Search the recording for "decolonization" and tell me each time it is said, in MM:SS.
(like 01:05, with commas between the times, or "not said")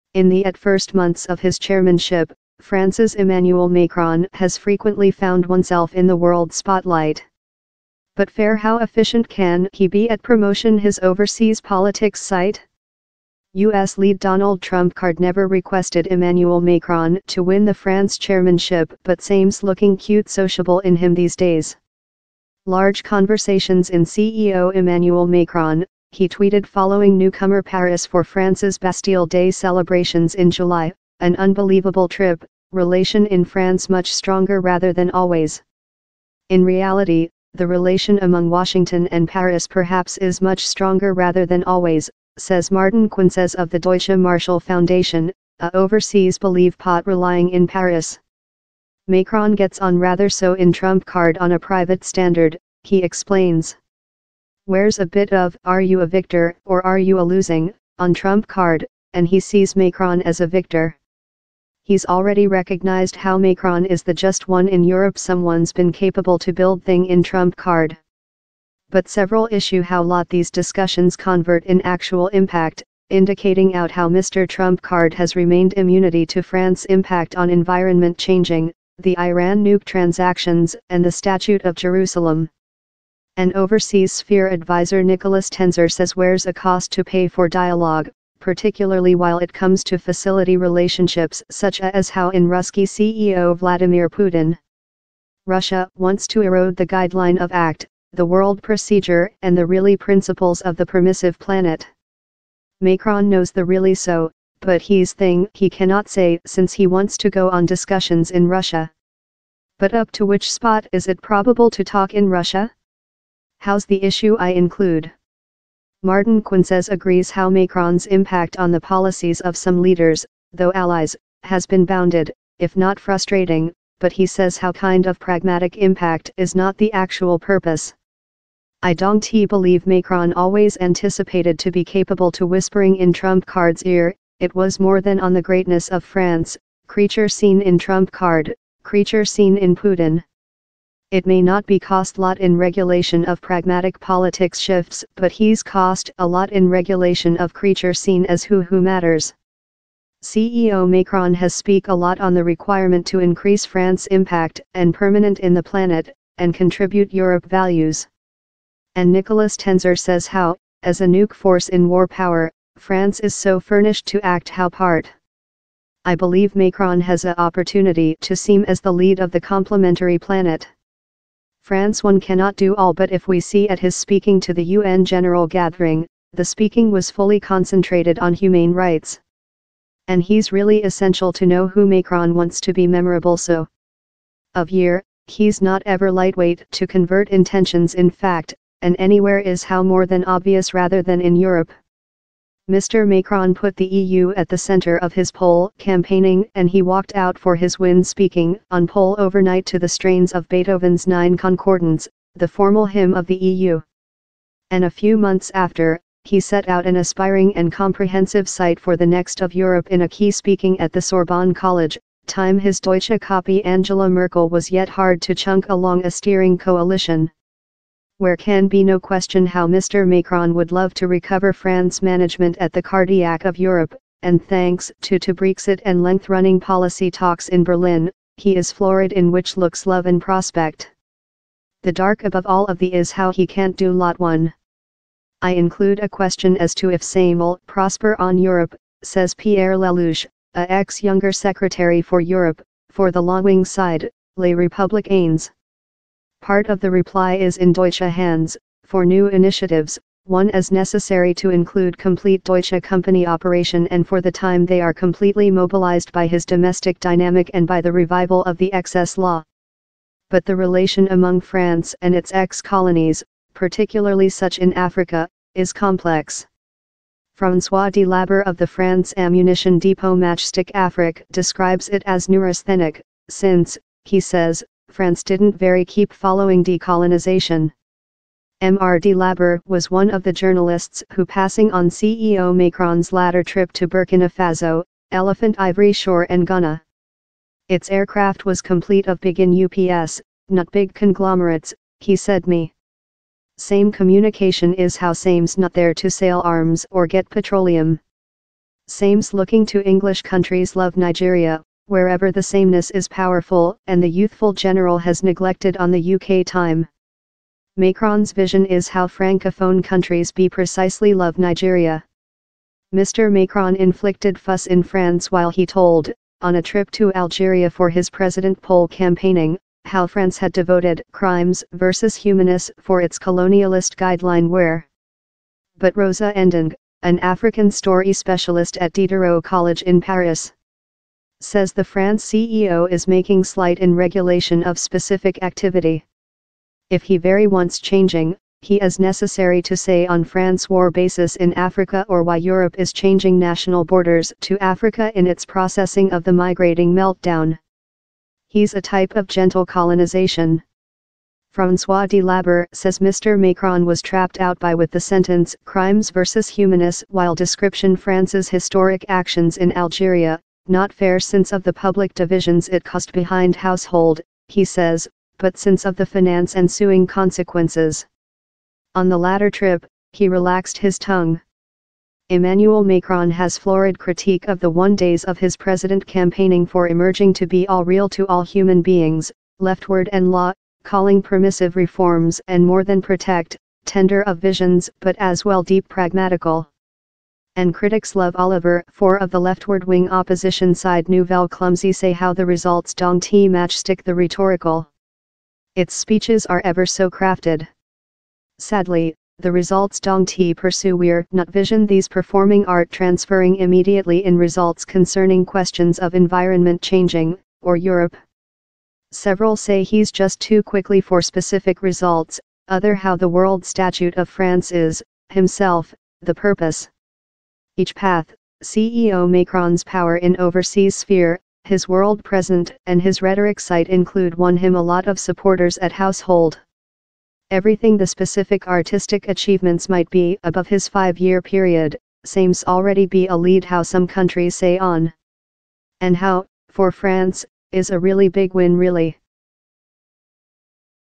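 04:36.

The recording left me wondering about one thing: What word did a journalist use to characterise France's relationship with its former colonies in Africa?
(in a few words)
Neurasthenic.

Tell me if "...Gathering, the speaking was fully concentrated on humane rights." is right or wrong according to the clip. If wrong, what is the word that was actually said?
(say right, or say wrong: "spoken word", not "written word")
right.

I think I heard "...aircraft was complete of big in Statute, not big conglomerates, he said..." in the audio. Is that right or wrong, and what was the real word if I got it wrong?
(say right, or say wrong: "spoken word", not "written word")
wrong: "UPS", not "Statute".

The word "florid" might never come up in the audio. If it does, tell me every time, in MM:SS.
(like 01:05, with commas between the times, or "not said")
03:48, 06:13.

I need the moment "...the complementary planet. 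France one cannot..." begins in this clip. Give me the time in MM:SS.
02:49.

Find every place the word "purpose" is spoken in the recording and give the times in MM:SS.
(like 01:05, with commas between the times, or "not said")
02:07, 06:56.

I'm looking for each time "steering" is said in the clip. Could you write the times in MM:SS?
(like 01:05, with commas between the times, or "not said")
03:36.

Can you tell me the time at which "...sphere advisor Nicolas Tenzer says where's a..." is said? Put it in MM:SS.
01:24.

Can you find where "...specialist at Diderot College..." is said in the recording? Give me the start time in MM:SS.
05:28.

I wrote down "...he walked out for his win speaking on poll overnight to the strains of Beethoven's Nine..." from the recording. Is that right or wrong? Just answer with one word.
right.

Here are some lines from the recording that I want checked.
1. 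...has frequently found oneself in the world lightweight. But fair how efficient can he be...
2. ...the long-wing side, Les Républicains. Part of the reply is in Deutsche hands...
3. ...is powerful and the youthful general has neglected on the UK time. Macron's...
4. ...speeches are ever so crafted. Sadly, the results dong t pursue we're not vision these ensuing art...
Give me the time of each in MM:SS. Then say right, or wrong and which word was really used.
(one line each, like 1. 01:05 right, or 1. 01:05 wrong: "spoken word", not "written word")
1. 00:04 wrong: "spotlight", not "lightweight"
2. 04:03 right
3. 05:02 right
4. 06:35 wrong: "performing", not "ensuing".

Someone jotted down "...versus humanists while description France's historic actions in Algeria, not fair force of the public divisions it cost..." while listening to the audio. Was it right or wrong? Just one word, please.
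wrong.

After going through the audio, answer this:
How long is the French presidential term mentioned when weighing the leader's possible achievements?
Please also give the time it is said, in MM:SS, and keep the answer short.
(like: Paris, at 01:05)
5 years, at 07:10.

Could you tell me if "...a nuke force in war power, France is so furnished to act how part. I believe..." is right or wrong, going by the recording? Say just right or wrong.
right.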